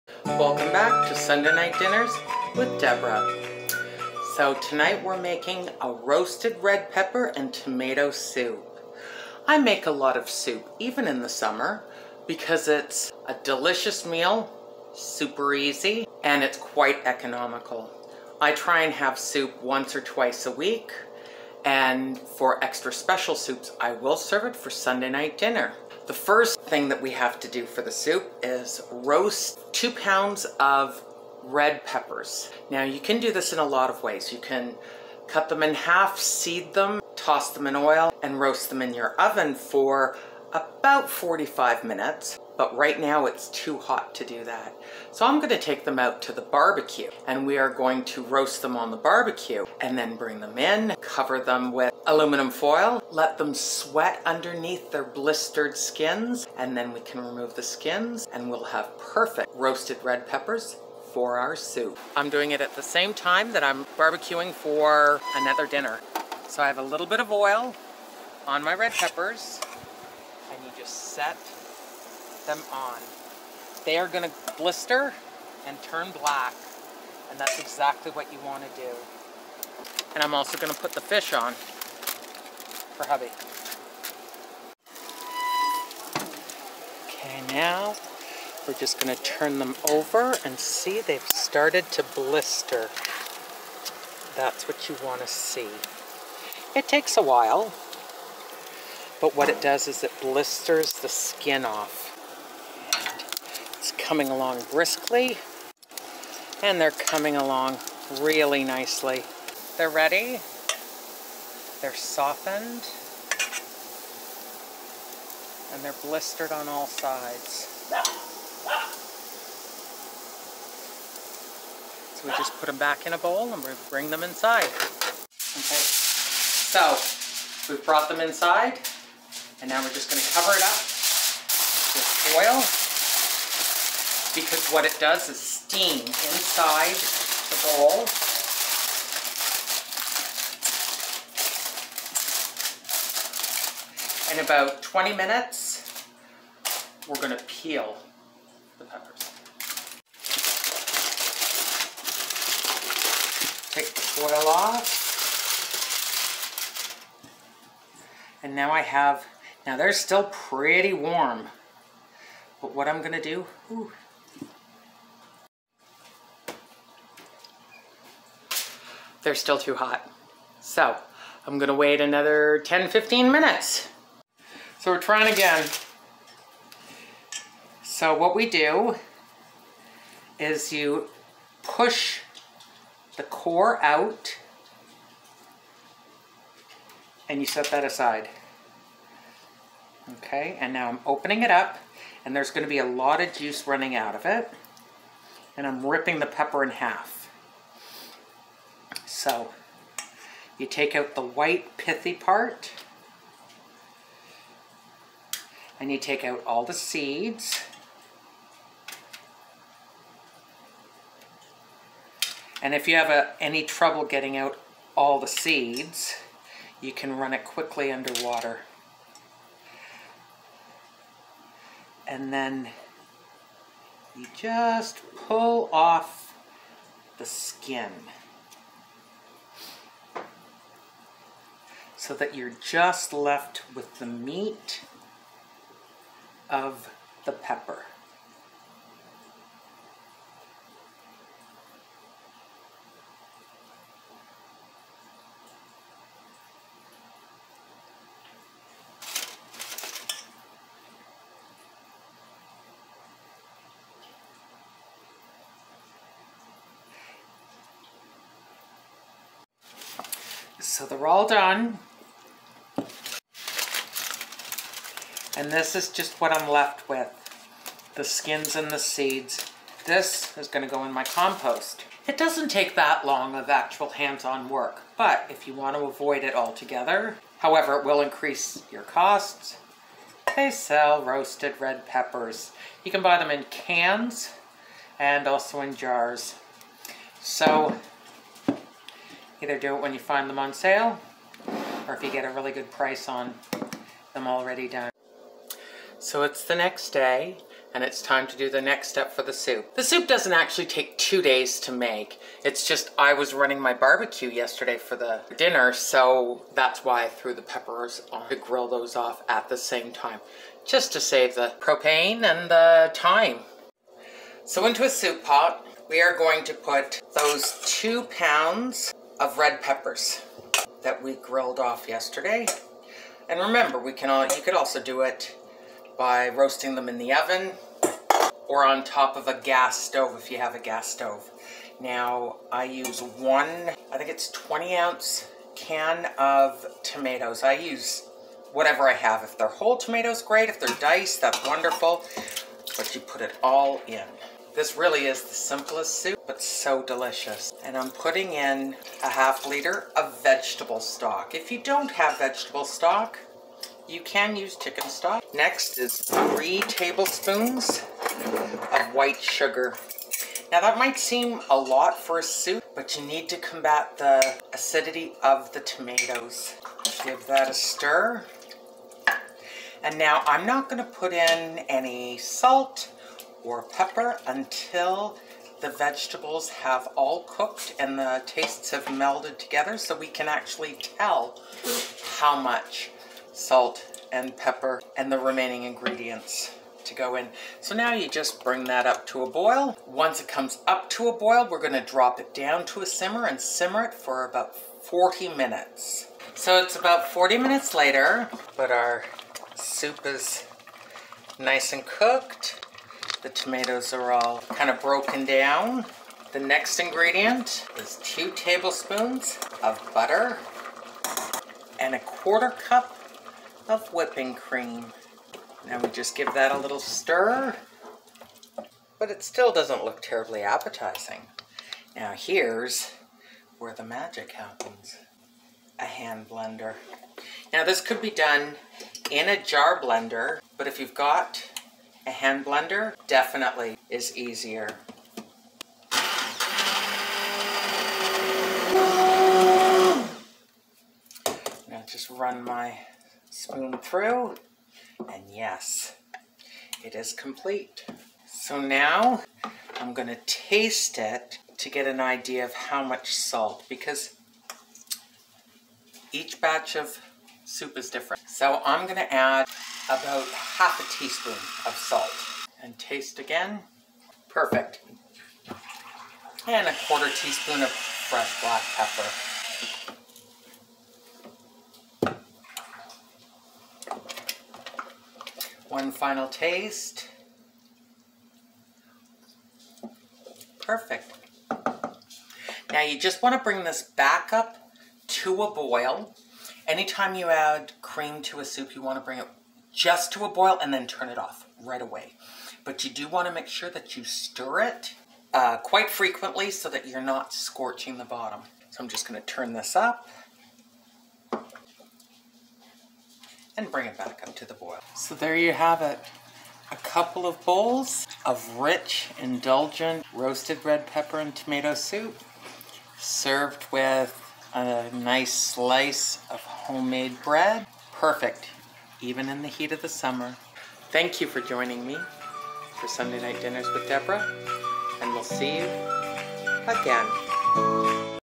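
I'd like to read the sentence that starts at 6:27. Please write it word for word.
So now you just bring that up to a boil.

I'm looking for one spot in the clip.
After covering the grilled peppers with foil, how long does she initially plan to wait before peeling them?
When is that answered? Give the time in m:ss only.
2:24.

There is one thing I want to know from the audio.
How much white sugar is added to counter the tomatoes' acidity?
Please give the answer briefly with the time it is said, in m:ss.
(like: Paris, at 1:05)
3 tablespoons, at 5:55.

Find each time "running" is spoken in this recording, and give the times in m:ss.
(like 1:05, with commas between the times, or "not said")
3:13, 5:03.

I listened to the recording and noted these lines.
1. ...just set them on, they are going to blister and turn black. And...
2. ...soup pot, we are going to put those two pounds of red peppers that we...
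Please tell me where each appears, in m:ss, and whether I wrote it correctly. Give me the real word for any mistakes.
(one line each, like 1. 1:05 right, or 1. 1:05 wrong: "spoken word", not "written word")
1. 1:10 right
2. 5:14 right.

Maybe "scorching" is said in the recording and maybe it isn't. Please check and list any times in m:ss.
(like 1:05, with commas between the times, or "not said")
8:17.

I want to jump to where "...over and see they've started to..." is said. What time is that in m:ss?
1:29.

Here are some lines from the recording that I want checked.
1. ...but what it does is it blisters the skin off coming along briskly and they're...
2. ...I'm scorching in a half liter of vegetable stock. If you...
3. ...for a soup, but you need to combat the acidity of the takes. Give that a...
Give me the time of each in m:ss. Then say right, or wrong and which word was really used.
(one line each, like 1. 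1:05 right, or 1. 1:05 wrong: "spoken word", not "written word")
1. 1:39 right
2. 5:47 wrong: "putting", not "scorching"
3. 6:01 wrong: "tomatoes", not "takes".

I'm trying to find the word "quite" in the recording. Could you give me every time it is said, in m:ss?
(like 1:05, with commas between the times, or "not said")
0:16, 8:15.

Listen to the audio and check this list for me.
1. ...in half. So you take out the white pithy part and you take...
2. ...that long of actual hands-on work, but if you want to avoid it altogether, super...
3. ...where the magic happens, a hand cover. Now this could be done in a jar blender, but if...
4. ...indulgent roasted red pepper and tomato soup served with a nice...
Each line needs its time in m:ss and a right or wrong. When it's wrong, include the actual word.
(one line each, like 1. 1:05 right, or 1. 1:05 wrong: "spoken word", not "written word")
1. 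3:16 right
2. 4:32 wrong: "however", not "super"
3. 7:03 wrong: "blender", not "cover"
4. 8:29 right.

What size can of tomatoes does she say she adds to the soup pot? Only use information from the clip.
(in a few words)
20 ounce.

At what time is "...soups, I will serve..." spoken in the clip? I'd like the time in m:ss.
0:23.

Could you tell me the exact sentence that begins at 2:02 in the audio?
So we just put them back in a bowl and we bring them inside.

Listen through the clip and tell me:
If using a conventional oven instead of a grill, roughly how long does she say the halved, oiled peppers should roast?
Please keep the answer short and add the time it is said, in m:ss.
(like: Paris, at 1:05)
45 minutes, at 0:40.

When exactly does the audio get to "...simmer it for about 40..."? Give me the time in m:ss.
6:33.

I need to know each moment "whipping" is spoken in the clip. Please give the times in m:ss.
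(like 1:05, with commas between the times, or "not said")
6:53.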